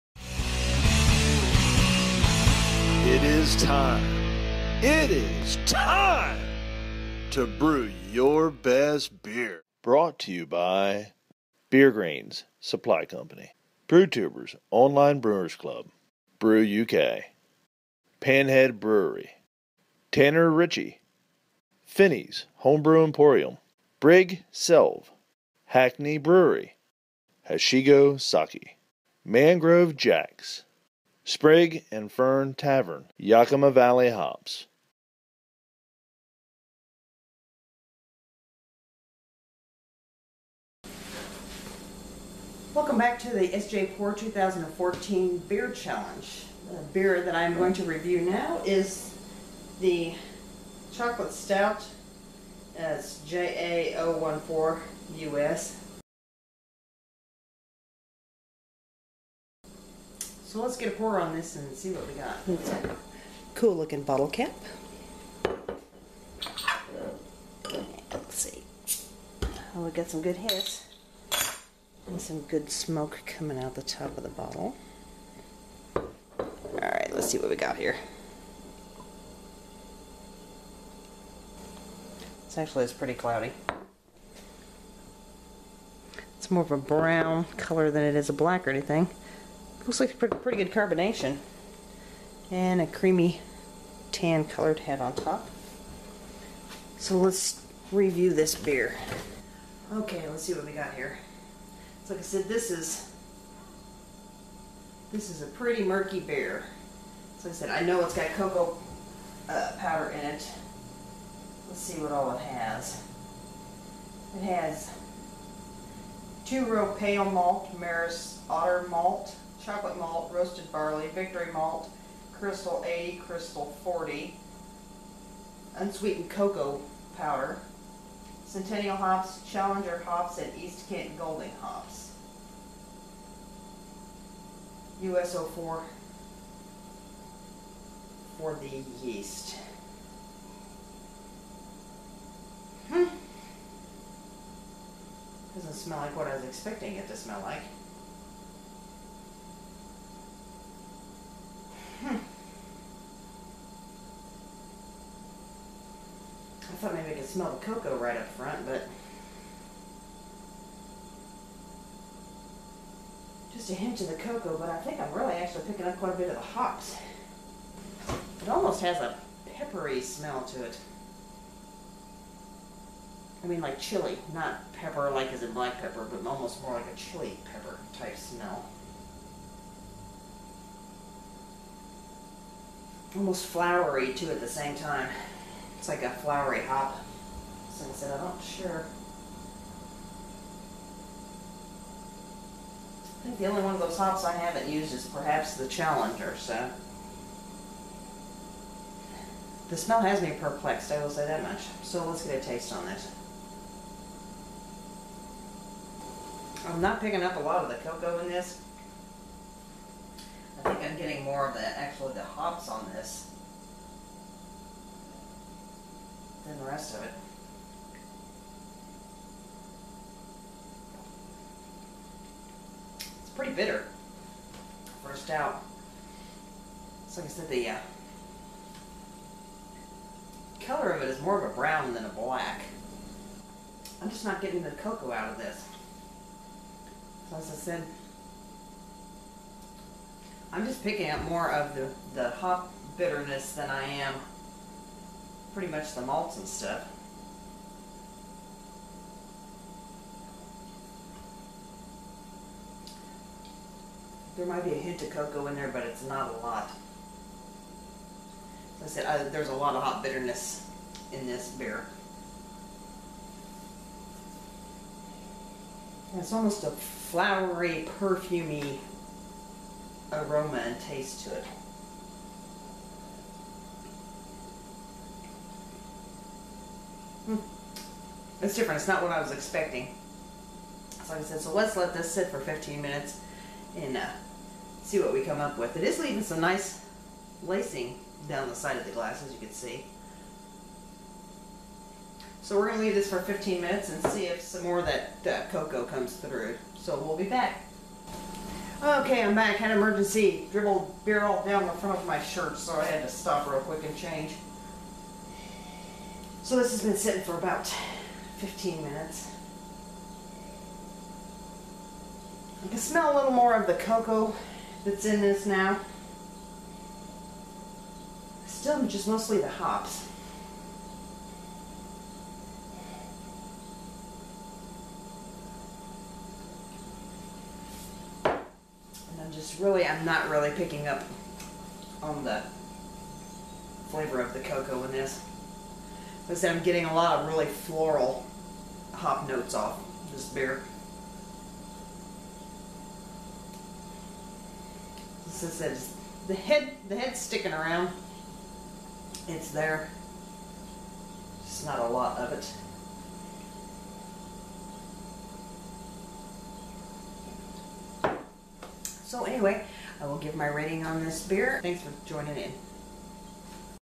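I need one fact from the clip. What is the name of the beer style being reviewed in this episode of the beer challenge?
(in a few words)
Chocolate Stout.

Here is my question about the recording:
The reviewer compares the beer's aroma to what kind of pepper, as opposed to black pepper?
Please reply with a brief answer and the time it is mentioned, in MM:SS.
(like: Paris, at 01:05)
Chili pepper, at 02:56.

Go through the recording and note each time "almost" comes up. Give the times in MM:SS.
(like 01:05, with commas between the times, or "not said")
02:48, 02:56, 03:03, 04:26.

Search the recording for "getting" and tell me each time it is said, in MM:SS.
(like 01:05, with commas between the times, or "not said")
03:30, 03:54, 05:36.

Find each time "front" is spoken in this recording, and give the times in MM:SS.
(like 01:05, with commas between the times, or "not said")
02:38, 05:01.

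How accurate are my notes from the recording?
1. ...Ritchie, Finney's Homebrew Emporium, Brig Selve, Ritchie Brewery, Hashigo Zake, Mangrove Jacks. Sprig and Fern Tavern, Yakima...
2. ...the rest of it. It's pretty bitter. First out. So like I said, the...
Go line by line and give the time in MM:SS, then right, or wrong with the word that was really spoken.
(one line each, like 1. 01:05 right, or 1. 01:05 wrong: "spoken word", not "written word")
1. 00:20 wrong: "Hackney", not "Ritchie"
2. 03:36 right.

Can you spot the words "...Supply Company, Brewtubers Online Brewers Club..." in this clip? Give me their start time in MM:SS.
00:12.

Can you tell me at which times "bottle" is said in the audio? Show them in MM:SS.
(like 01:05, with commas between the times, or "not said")
01:04, 01:14.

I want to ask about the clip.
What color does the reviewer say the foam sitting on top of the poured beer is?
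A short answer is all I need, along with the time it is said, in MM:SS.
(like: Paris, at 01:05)
Tan, at 01:34.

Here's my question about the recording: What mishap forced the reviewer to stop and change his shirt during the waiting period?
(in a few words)
Dribbled beer.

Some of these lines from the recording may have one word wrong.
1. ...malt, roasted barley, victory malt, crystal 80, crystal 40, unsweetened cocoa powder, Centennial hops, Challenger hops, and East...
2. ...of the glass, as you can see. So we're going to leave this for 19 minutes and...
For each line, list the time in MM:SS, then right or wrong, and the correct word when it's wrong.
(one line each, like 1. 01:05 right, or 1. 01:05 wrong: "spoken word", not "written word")
1. 01:59 right
2. 04:48 wrong: "15", not "19".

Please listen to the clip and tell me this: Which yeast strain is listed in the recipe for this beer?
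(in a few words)
US-04.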